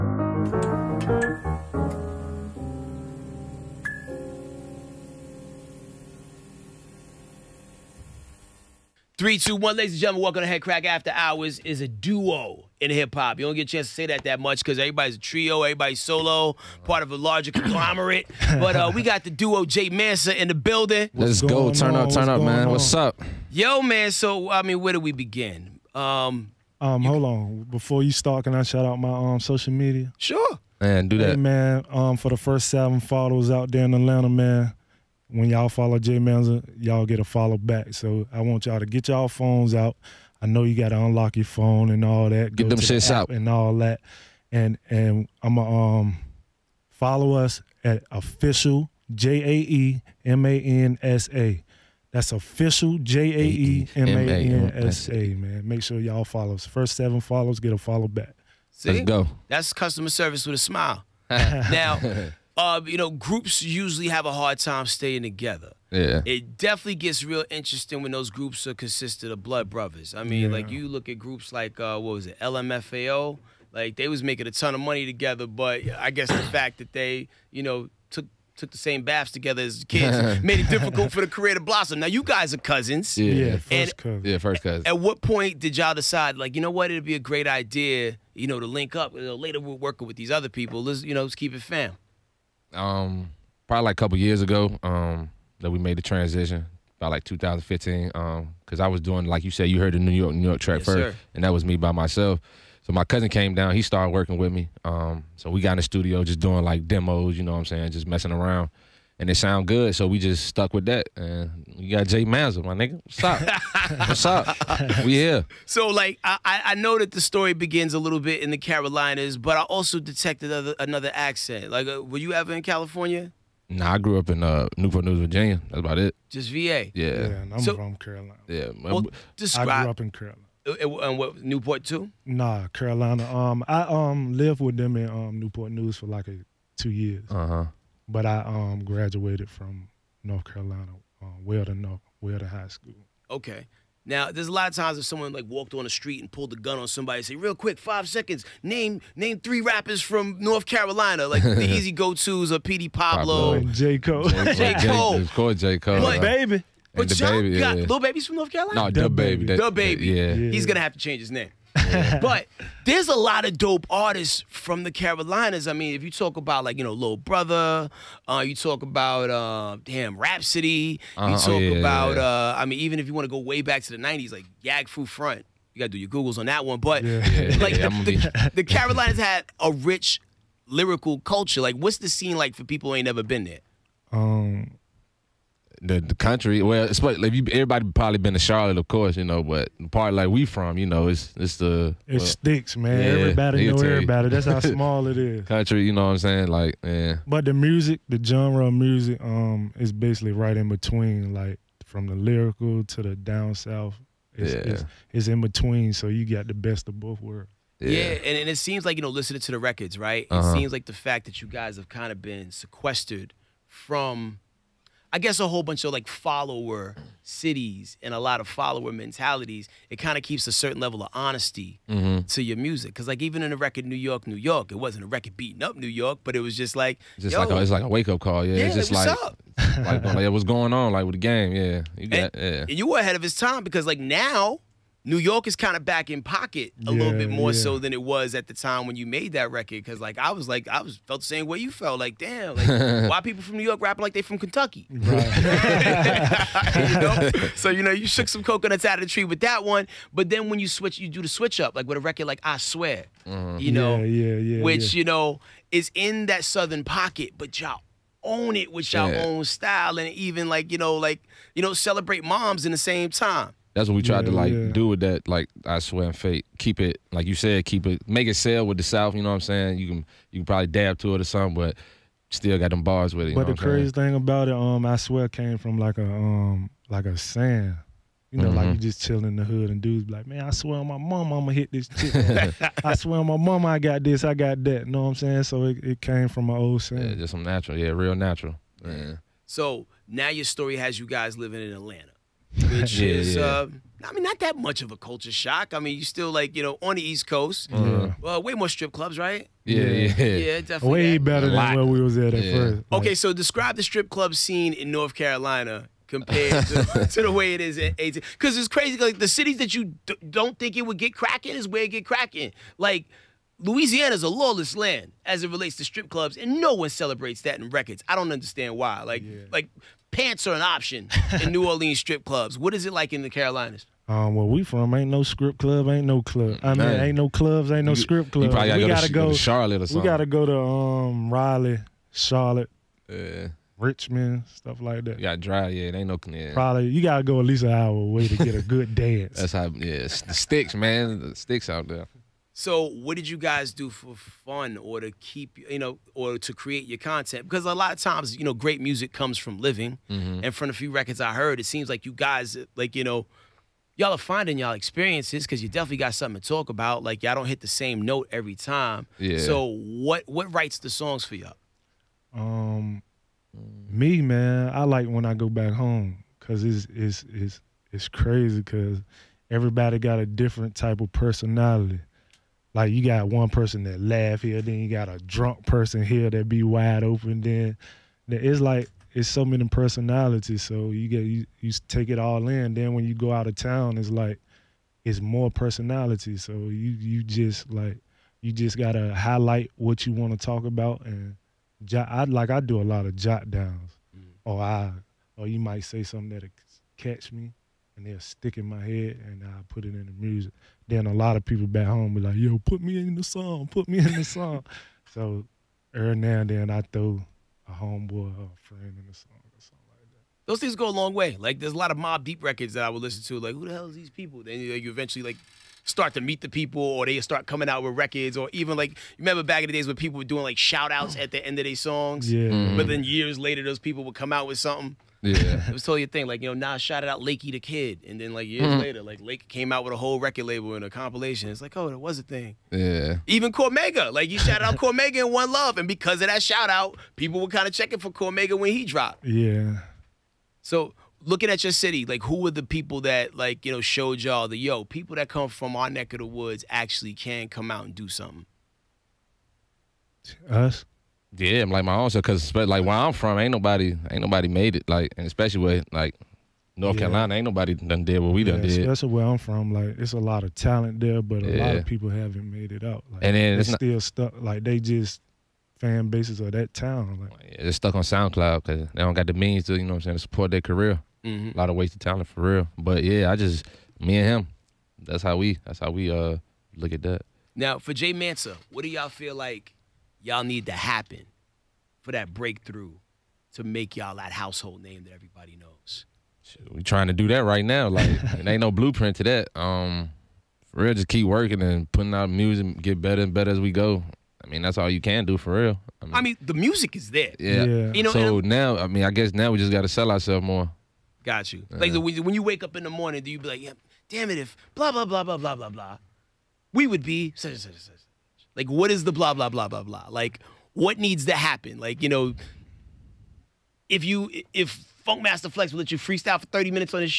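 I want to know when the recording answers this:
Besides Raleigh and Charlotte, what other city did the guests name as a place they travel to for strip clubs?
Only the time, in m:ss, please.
5:33.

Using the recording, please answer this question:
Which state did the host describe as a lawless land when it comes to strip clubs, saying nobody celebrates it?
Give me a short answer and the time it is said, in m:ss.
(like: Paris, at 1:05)
Louisiana, at 5:13.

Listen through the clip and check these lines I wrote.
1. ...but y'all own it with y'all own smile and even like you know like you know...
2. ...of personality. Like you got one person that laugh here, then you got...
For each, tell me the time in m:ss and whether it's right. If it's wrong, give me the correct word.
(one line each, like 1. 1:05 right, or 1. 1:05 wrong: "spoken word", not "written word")
1. 4:17 wrong: "style", not "smile"
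2. 6:10 right.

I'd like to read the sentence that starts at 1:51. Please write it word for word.
And you got Jae Mansa, my nigga.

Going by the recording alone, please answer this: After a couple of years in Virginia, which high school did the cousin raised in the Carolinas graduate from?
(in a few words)
Weldon High School.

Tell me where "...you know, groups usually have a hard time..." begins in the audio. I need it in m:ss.
1:02.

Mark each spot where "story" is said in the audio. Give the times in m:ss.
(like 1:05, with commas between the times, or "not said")
1:57, 4:50.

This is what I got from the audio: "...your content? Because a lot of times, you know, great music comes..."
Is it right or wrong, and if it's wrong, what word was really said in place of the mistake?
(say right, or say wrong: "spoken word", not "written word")
right.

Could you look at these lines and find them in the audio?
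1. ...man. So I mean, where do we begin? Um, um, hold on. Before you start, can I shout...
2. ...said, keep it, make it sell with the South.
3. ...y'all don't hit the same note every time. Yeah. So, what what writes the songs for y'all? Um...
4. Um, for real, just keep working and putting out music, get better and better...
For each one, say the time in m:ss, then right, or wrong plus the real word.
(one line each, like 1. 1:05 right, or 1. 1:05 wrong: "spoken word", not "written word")
1. 0:23 right
2. 4:27 right
3. 5:57 right
4. 8:09 right.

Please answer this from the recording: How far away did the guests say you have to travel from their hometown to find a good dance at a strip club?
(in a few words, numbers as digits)
at least an hour.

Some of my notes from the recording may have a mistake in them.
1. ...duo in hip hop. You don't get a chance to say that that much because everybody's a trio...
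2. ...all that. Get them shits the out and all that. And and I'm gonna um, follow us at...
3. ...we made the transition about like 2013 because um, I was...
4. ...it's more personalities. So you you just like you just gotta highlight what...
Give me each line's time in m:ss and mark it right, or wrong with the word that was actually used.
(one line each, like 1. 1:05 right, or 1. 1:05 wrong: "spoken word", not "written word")
1. 0:11 right
2. 0:42 right
3. 1:35 wrong: "2015", not "2013"
4. 6:25 right.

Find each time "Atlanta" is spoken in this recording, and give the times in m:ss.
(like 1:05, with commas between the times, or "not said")
0:33, 4:51.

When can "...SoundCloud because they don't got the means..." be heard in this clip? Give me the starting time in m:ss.
7:48.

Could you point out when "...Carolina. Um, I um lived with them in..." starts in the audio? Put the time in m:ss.
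2:12.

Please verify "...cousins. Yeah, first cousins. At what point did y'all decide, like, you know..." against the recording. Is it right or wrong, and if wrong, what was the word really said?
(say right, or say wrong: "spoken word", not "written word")
right.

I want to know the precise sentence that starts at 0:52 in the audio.
That's official J A E M A N S A.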